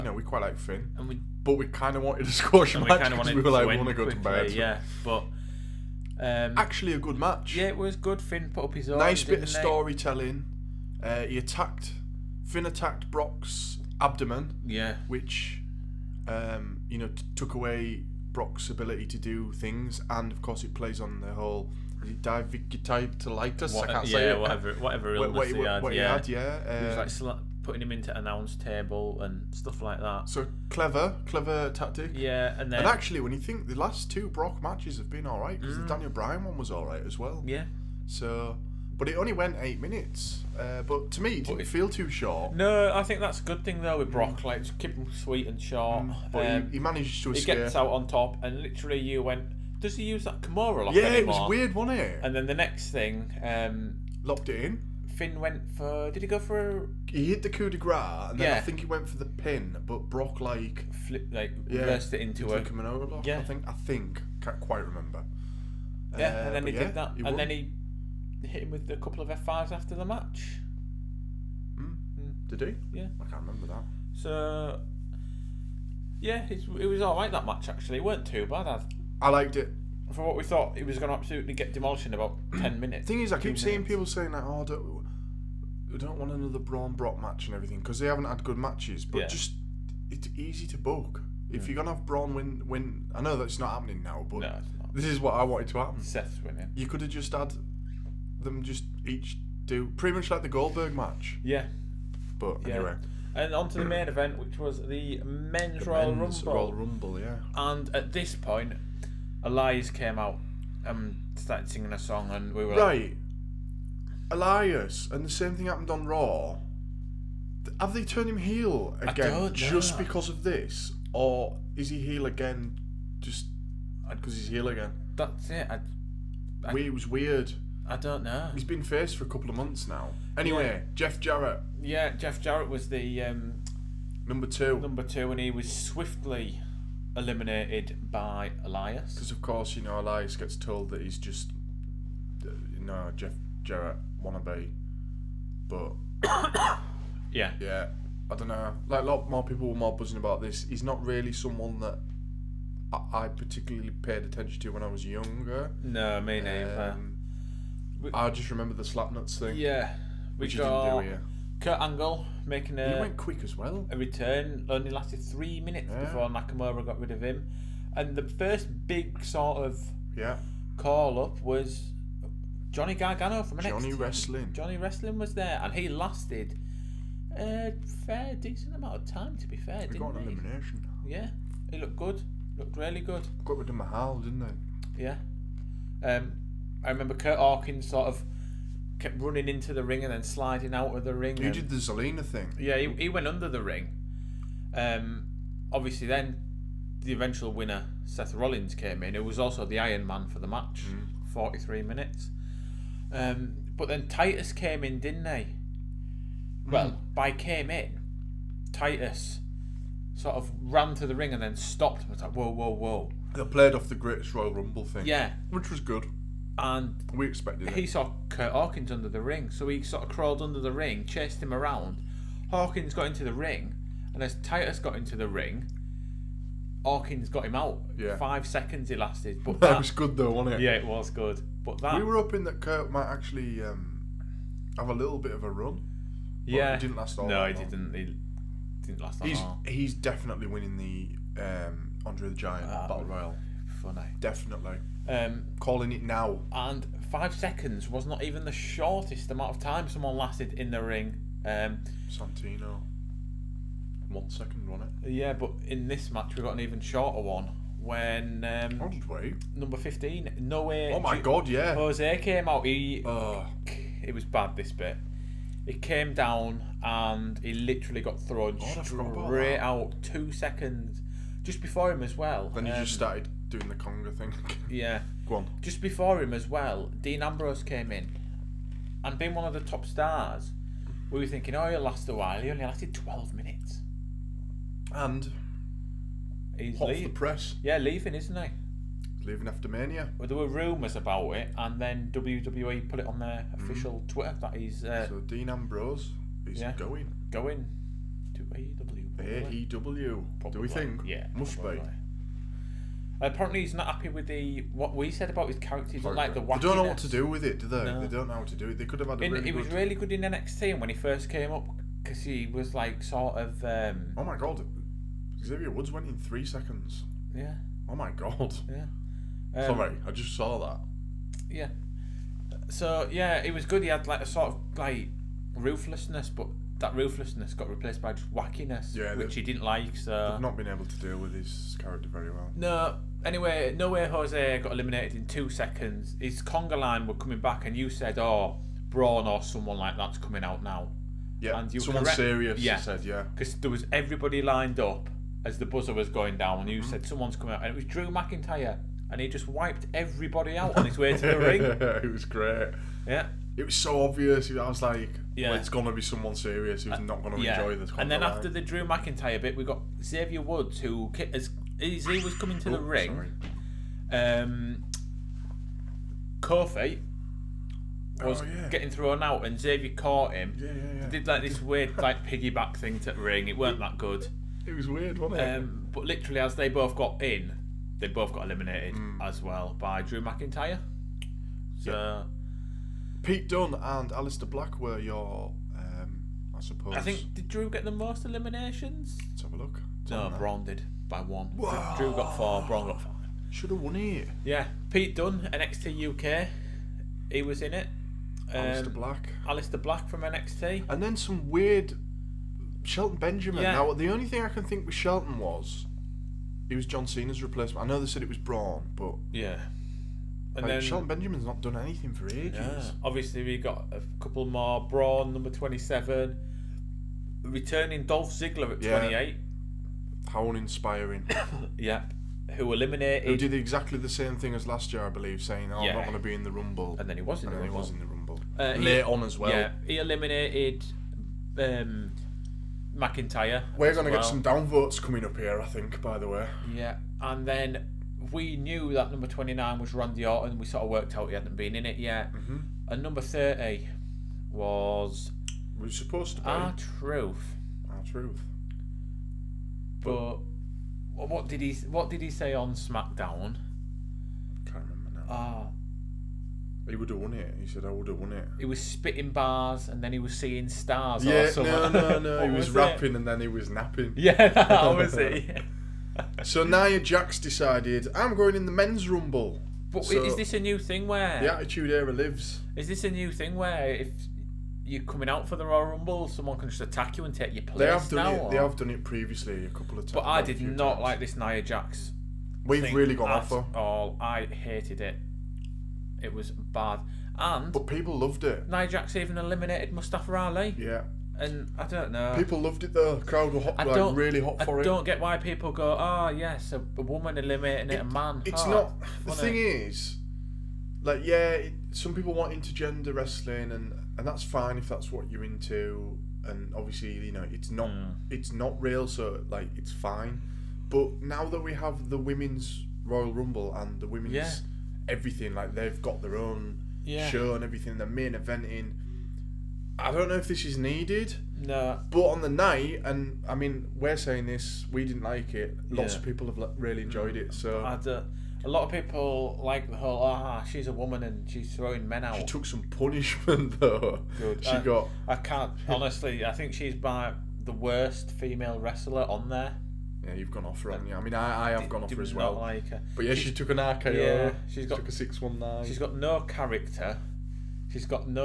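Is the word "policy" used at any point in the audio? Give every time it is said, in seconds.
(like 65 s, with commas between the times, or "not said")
not said.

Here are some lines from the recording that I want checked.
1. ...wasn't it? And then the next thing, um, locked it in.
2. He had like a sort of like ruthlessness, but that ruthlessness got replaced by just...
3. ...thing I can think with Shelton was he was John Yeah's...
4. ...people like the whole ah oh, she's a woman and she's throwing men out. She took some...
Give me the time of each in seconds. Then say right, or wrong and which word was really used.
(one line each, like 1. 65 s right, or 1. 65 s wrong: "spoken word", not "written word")
1. 51 s right
2. 323 s right
3. 404 s wrong: "Cena", not "Yeah"
4. 528 s right.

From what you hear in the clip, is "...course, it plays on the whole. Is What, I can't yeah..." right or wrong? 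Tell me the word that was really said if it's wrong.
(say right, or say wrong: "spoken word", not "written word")
right.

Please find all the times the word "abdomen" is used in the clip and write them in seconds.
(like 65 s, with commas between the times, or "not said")
14 s.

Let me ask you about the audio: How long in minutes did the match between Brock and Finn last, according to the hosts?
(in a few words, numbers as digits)
8.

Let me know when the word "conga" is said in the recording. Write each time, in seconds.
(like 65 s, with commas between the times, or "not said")
273 s, 336 s.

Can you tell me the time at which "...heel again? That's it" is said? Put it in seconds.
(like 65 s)
124 s.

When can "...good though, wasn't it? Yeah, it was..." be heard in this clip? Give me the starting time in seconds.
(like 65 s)
229 s.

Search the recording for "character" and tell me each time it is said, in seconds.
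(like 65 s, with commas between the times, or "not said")
305 s, 331 s, 546 s.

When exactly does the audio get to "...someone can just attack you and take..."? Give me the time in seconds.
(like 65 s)
476 s.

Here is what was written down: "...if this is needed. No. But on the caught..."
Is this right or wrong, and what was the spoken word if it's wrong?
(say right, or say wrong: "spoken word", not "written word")
wrong: "night", not "caught".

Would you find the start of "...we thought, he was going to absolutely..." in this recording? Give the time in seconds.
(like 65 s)
80 s.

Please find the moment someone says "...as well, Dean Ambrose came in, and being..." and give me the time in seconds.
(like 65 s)
276 s.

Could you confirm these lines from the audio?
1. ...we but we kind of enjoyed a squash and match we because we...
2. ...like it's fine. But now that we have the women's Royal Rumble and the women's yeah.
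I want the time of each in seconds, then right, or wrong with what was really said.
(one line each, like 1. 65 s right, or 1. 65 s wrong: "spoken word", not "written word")
1. 1 s wrong: "wanted", not "enjoyed"
2. 509 s right.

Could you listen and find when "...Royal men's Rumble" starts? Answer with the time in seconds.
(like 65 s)
105 s.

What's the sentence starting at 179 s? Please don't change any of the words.
To be fair, he didn't got an he?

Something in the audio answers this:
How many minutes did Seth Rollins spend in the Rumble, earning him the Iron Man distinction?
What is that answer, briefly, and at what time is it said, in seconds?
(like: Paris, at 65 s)
43, at 201 s.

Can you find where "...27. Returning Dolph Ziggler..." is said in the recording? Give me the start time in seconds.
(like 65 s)
415 s.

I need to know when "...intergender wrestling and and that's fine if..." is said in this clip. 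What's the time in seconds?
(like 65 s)
502 s.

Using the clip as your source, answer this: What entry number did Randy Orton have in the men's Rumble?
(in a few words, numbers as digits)
29.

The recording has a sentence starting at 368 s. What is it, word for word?
getting thrown out, and Xavier caught him.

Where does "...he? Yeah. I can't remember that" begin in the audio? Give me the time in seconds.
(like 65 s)
72 s.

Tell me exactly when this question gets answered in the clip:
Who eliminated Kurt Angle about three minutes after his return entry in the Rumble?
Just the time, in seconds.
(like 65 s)
166 s.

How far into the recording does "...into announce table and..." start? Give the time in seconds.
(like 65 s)
27 s.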